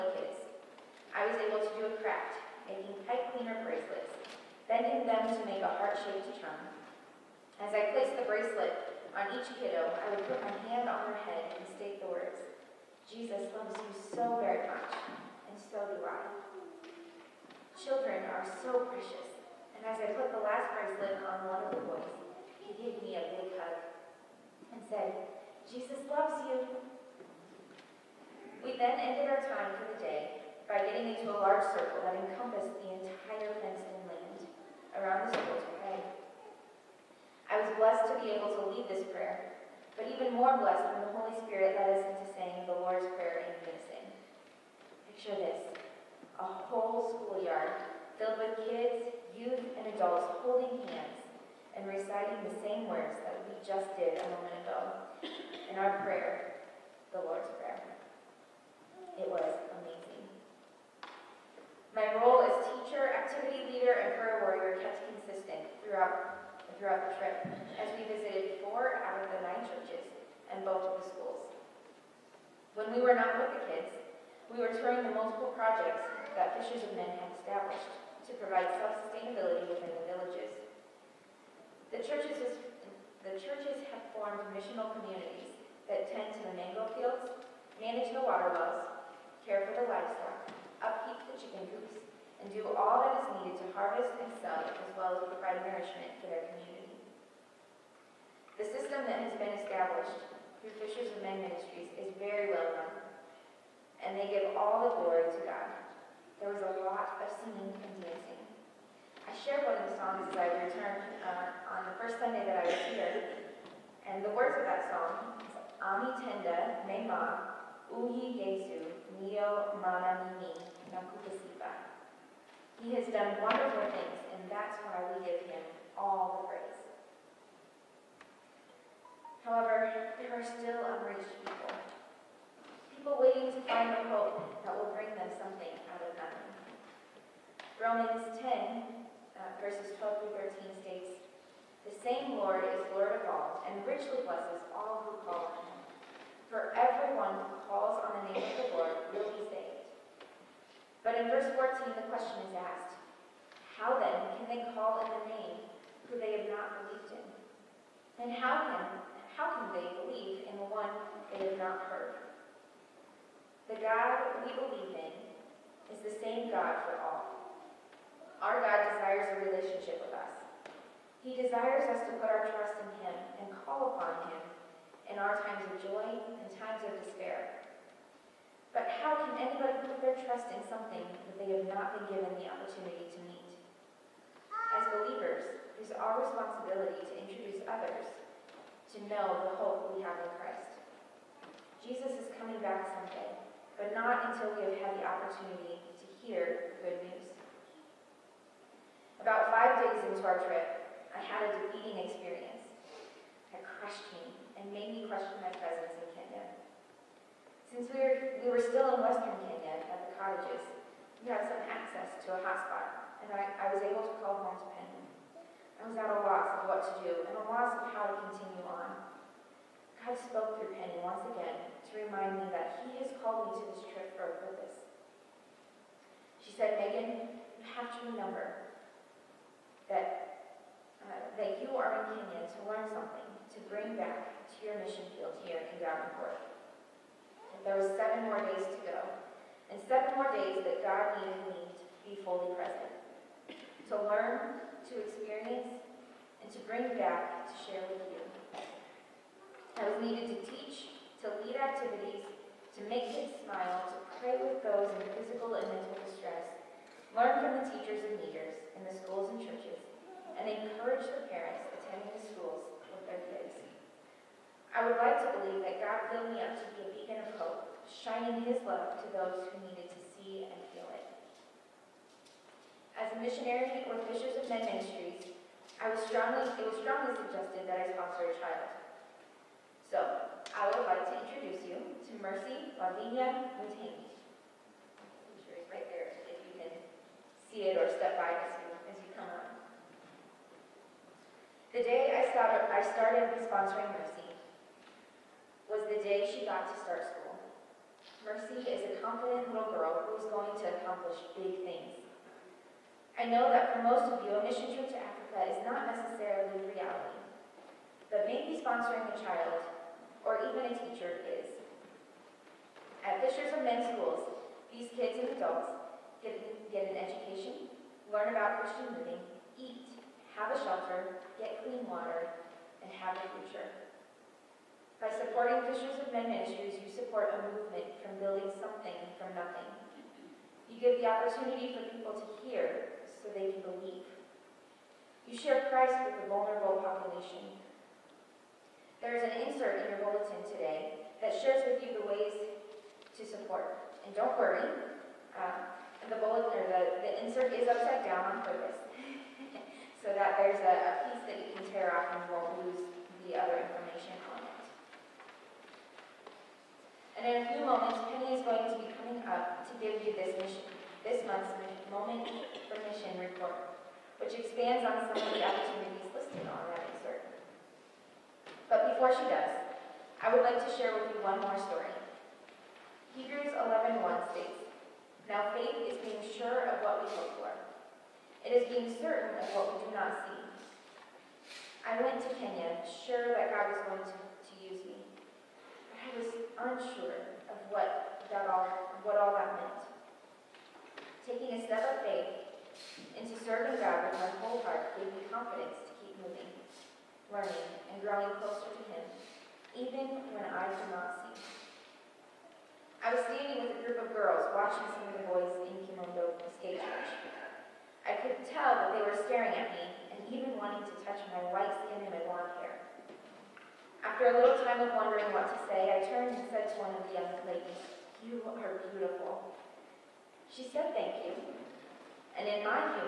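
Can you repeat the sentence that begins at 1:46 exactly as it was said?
There was a lot of singing and dancing.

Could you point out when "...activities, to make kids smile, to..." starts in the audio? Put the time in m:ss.
4:11.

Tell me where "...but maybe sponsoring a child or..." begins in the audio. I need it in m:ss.
5:08.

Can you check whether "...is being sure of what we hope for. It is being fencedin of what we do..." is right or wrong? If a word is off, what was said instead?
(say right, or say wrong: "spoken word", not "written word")
wrong: "certain", not "fencedin".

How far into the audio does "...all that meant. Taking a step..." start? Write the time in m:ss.
6:29.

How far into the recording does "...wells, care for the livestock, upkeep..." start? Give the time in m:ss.
1:28.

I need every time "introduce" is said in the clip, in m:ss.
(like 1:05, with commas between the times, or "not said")
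3:07, 4:41.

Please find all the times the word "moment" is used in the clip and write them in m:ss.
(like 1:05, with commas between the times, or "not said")
0:54, 5:57, 6:01.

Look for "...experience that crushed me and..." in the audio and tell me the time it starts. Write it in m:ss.
3:22.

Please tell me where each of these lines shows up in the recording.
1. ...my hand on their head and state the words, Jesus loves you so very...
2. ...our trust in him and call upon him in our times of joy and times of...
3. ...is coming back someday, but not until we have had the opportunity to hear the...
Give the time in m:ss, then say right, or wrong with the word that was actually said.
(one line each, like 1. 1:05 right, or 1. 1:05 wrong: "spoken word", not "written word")
1. 0:10 right
2. 2:52 right
3. 3:12 right.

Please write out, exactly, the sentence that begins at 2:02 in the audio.
He has done wonderful things, and that's why we give him all the praise.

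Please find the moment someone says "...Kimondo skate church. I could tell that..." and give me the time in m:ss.
6:45.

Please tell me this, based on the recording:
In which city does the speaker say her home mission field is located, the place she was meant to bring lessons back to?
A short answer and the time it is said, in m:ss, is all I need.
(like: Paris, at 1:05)
Davenport, at 3:55.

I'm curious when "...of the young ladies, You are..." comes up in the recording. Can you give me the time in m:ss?
6:56.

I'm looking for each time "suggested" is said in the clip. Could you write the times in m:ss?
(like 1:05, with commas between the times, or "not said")
4:37.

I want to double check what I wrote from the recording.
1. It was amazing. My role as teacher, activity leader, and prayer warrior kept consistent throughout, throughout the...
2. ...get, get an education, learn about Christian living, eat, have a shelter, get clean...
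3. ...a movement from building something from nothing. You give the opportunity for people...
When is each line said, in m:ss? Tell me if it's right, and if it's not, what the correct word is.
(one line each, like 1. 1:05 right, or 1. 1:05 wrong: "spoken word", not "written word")
1. 0:59 right
2. 5:16 right
3. 5:27 right.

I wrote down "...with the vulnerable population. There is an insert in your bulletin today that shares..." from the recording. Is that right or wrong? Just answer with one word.
right.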